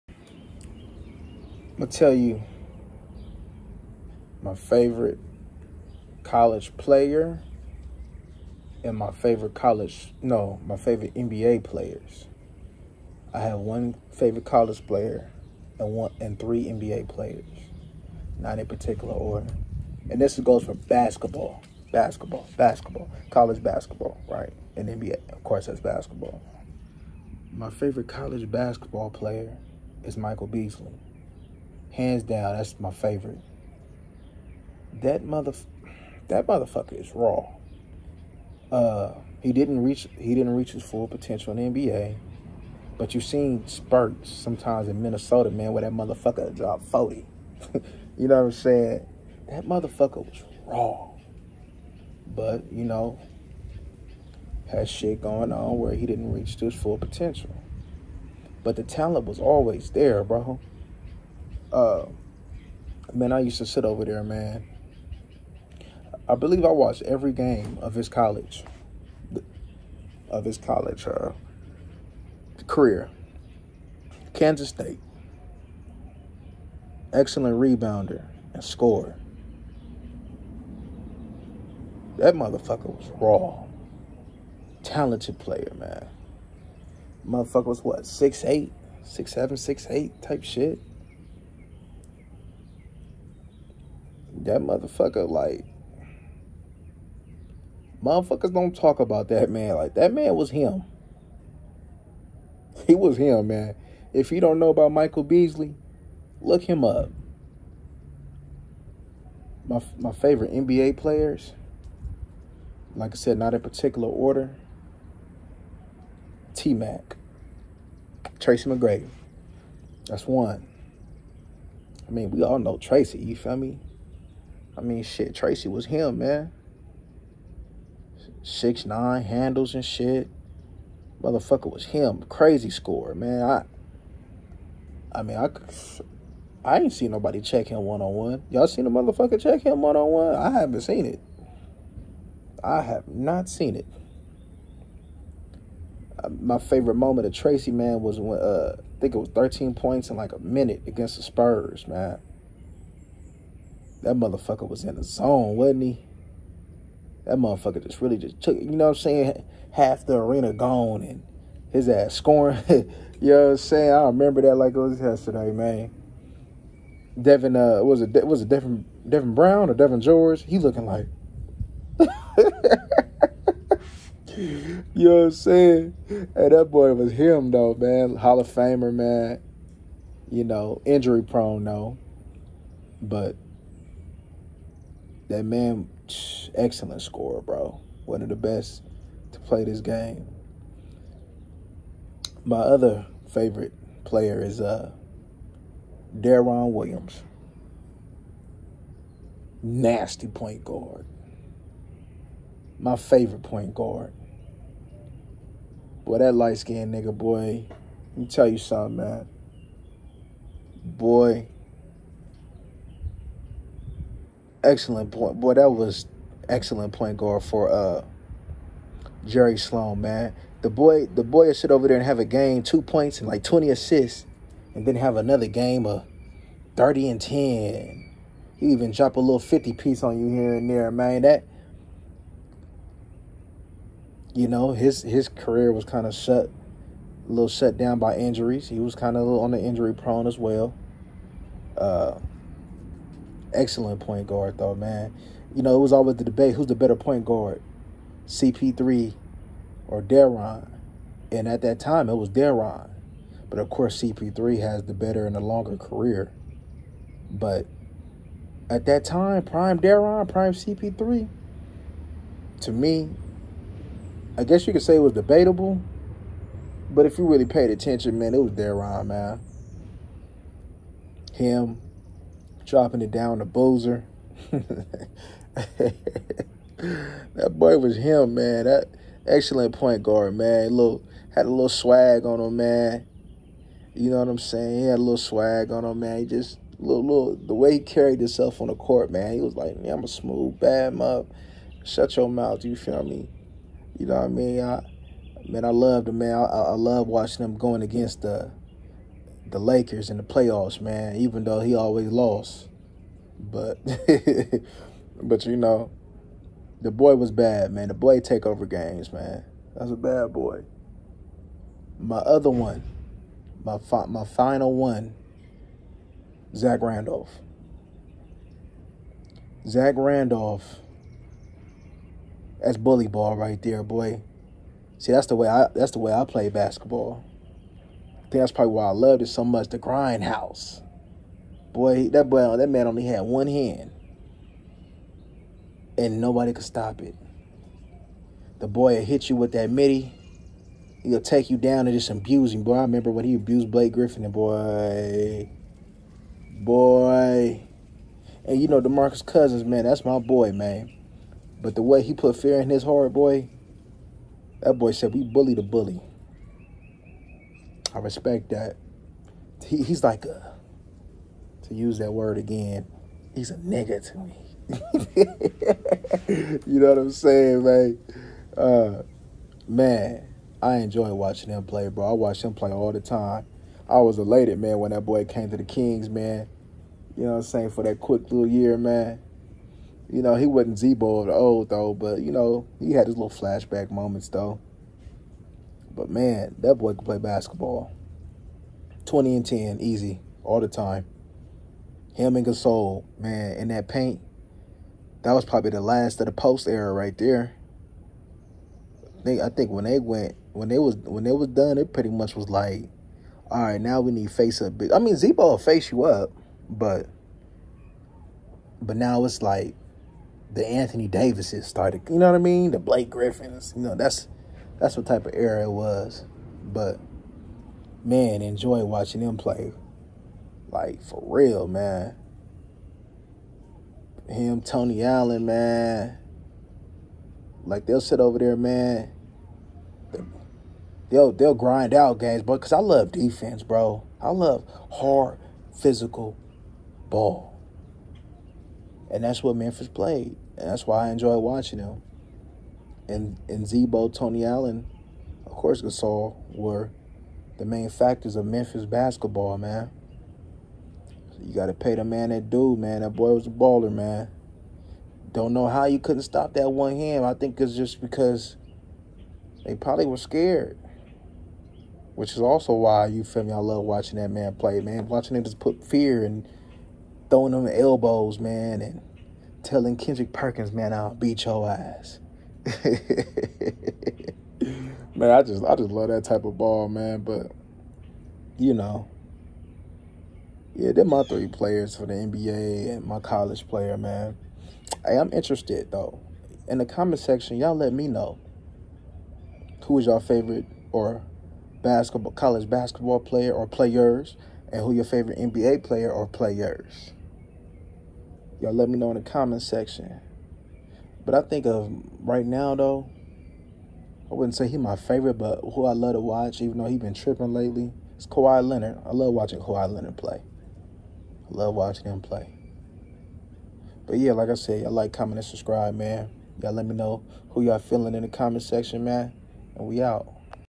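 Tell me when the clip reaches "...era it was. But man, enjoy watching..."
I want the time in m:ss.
6:55.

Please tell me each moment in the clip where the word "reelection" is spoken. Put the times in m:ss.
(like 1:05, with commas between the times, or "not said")
not said.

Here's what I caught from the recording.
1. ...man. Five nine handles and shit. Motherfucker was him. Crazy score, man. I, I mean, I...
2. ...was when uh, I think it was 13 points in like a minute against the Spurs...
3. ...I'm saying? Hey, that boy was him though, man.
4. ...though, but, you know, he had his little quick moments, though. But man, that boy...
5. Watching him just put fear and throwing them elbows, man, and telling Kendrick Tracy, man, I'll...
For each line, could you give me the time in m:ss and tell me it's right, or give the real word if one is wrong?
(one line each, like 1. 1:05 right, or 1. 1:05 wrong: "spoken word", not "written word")
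1. 2:06 wrong: "Six", not "Five"
2. 2:28 right
3. 2:55 right
4. 6:21 wrong: "flashback", not "quick"
5. 7:45 wrong: "Perkins", not "Tracy".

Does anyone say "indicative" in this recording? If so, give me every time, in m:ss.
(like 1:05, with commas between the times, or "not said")
not said.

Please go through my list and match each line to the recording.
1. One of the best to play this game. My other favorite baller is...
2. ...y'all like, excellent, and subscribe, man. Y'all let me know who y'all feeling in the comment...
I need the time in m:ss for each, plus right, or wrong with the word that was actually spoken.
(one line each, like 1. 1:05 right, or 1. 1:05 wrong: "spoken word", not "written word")
1. 3:08 wrong: "player", not "baller"
2. 8:34 wrong: "comment", not "excellent".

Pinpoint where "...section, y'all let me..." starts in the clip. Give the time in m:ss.
8:07.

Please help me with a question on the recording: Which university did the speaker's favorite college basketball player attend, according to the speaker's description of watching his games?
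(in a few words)
Kansas State.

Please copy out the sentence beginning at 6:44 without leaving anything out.
I mean, Z-Bo will face you up, but but now it's like the Anthony Davises started.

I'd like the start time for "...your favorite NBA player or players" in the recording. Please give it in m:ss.
8:14.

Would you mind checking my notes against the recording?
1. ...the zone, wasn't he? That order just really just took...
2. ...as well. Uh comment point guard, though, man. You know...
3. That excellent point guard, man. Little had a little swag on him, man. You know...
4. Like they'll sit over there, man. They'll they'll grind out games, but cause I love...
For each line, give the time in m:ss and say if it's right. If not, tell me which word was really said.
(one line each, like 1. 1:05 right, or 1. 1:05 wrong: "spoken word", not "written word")
1. 2:34 wrong: "motherfucker", not "order"
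2. 4:00 wrong: "excellent", not "comment"
3. 4:38 right
4. 7:07 right.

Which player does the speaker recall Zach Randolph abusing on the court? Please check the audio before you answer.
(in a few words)
Blake Griffin.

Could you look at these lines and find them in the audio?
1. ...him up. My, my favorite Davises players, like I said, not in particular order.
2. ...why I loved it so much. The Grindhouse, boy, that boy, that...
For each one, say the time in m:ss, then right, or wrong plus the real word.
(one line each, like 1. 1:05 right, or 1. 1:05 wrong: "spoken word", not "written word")
1. 1:46 wrong: "NBA", not "Davises"
2. 5:28 right.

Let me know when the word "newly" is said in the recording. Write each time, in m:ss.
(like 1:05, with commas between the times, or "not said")
not said.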